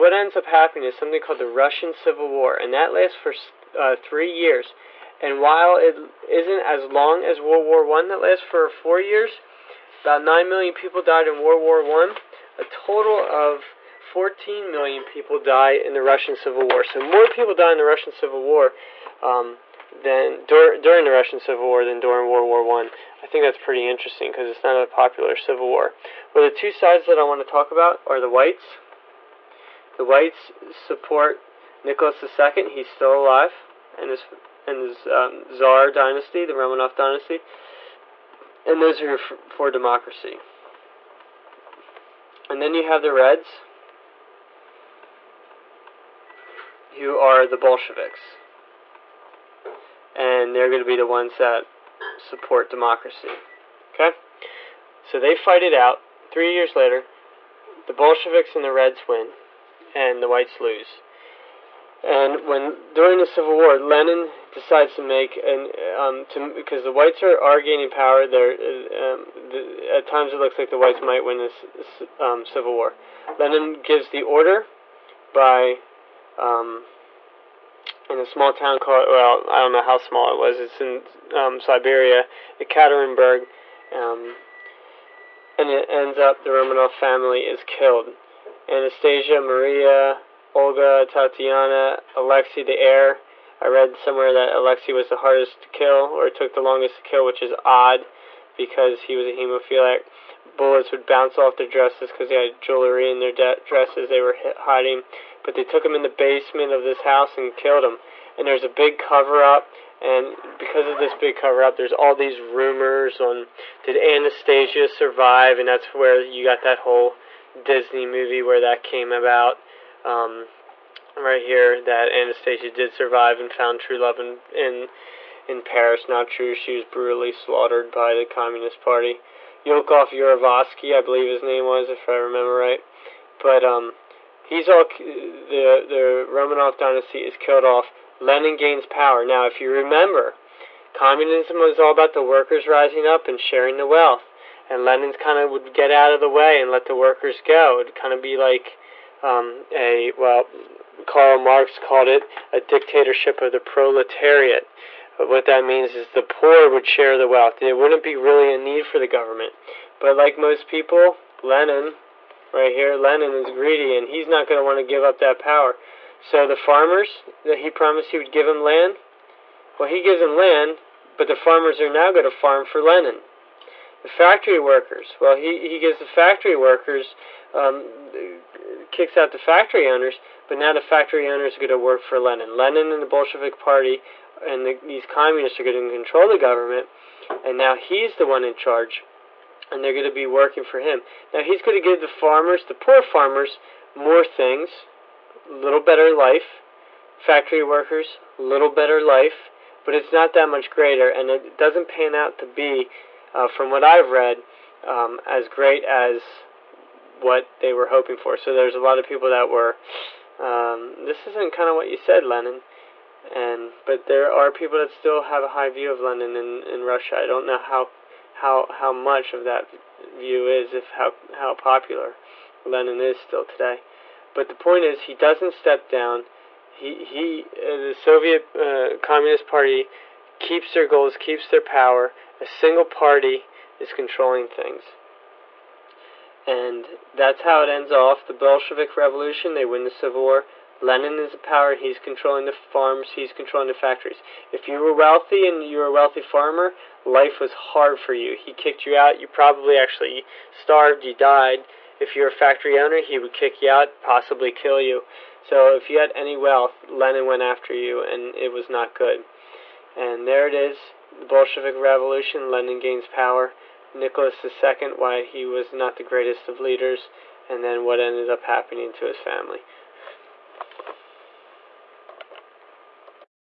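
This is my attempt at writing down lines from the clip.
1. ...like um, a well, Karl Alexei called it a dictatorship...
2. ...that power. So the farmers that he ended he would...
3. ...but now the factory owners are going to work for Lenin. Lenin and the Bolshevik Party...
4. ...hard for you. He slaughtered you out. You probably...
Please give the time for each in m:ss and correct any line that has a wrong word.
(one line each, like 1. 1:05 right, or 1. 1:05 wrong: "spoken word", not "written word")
1. 2:28 wrong: "Marx", not "Alexei"
2. 2:45 wrong: "promised", not "ended"
3. 3:00 right
4. 4:07 wrong: "kicked", not "slaughtered".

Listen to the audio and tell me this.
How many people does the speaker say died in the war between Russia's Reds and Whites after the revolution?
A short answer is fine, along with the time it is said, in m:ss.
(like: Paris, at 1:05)
14 million, at 0:13.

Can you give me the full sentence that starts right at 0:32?
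He's still alive, and his and his um, Tsar dynasty, the Romanov dynasty, and those are for, for democracy.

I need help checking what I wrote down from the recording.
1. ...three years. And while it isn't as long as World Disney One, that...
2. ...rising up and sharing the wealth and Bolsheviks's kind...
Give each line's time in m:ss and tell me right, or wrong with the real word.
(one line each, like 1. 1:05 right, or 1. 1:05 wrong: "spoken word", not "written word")
1. 0:03 wrong: "War", not "Disney"
2. 2:22 wrong: "Lenin", not "Bolsheviks".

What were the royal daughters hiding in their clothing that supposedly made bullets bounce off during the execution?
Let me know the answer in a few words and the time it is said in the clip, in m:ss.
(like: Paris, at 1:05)
jewelry, at 1:42.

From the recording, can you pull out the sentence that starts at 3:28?
So there's a lot of people that were, um, this isn't kind of what you said, Lenin.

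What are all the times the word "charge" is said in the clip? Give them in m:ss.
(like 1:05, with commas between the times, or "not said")
3:08.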